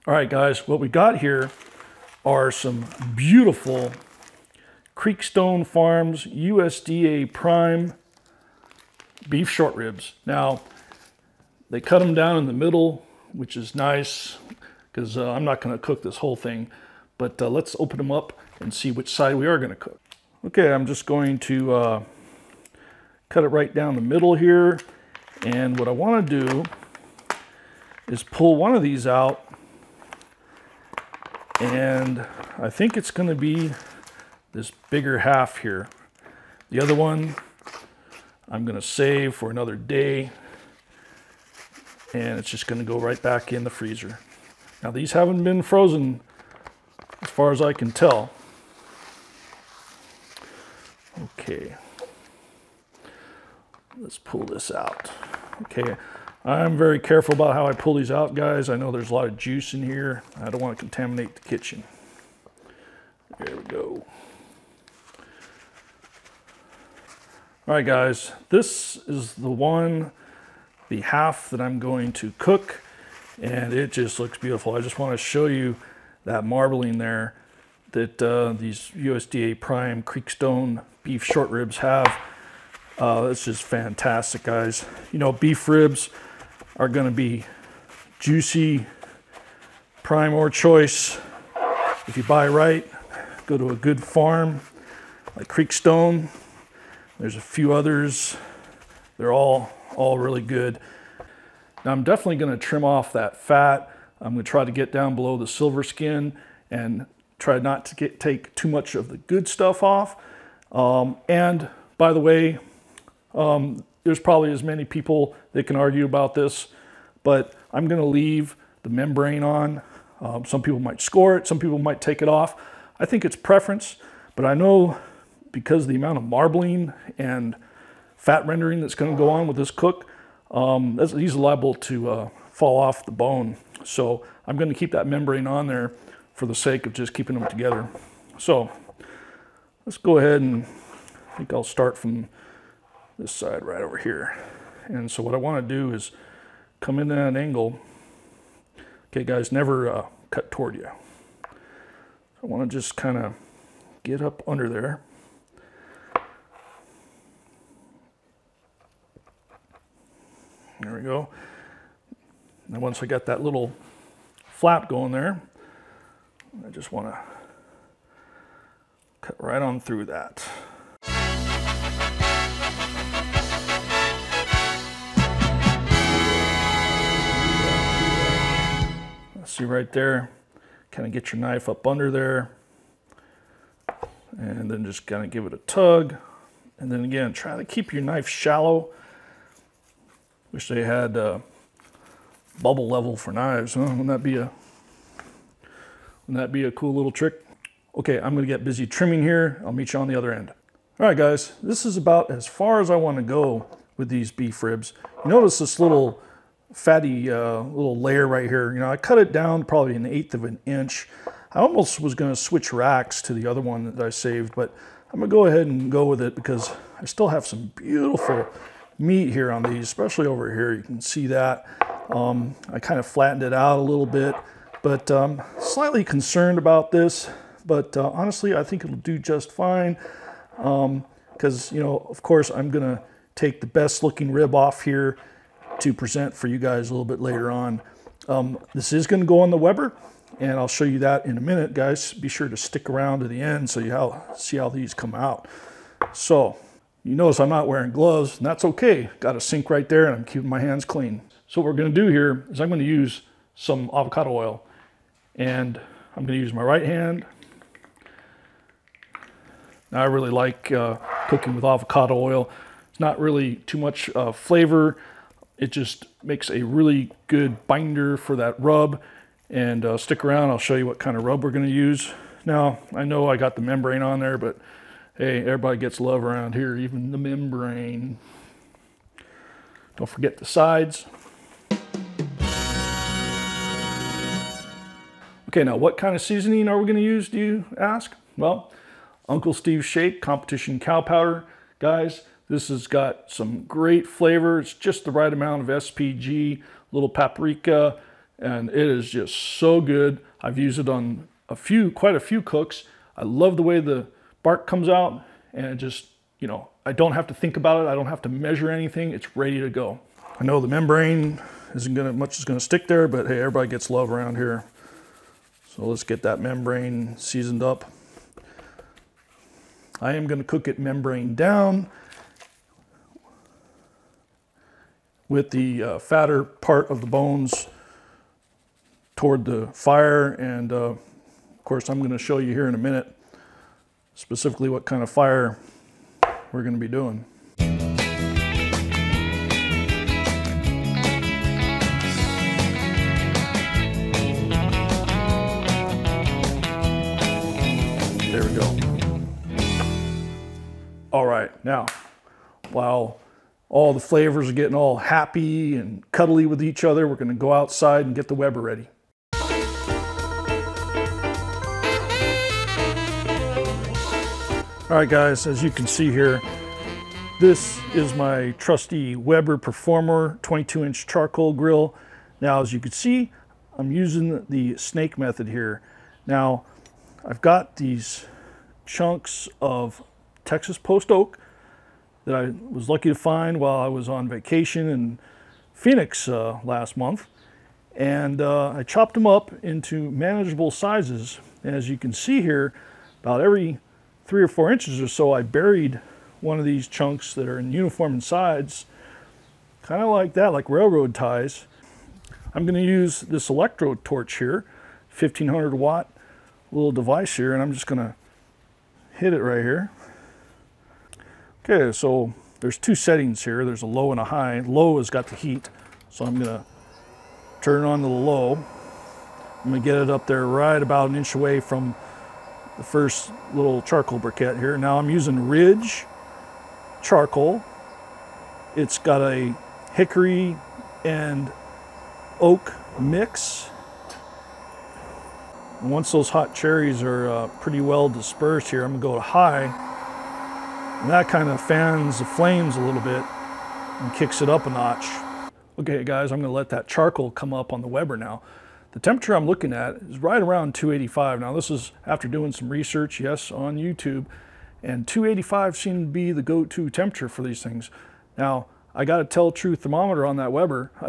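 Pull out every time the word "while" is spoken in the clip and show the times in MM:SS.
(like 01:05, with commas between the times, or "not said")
05:52, 06:23.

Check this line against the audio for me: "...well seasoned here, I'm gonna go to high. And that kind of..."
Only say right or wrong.
wrong.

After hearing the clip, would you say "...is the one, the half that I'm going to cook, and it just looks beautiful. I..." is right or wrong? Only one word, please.
right.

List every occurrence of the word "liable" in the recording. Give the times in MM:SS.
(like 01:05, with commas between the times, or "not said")
02:11.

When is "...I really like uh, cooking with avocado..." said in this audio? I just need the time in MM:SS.
04:19.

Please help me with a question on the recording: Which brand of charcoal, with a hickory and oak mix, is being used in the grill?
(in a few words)
Ridge.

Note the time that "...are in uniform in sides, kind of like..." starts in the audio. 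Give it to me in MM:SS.
06:37.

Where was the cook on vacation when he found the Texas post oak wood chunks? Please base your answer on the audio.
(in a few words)
Phoenix.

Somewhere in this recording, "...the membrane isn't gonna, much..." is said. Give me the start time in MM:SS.
05:10.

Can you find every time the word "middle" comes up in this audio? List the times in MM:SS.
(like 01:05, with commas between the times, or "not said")
00:12, 00:24.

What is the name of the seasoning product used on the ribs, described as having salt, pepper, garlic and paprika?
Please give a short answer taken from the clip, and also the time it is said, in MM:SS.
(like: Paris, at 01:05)
Competition Cow Powder, at 04:50.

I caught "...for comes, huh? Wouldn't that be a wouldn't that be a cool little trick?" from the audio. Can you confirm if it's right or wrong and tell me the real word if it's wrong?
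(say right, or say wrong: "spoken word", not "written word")
wrong: "knives", not "comes".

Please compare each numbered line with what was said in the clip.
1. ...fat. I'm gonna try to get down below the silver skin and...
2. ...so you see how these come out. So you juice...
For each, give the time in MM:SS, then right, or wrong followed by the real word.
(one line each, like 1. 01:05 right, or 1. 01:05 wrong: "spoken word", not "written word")
1. 01:43 right
2. 04:03 wrong: "notice", not "juice".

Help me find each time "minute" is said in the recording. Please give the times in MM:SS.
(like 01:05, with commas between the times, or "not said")
04:01, 05:32.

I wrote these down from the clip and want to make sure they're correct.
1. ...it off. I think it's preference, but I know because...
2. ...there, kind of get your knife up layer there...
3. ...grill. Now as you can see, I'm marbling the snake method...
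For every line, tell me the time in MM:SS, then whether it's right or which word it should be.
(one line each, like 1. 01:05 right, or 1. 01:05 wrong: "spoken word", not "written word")
1. 02:02 right
2. 02:59 wrong: "under", not "layer"
3. 06:11 wrong: "using", not "marbling".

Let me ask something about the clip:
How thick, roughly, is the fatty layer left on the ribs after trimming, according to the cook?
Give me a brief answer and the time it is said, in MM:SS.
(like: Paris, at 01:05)
an eighth of an inch, at 03:29.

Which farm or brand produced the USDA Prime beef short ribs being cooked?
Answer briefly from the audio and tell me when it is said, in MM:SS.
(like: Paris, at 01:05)
Creekstone Farms, at 00:04.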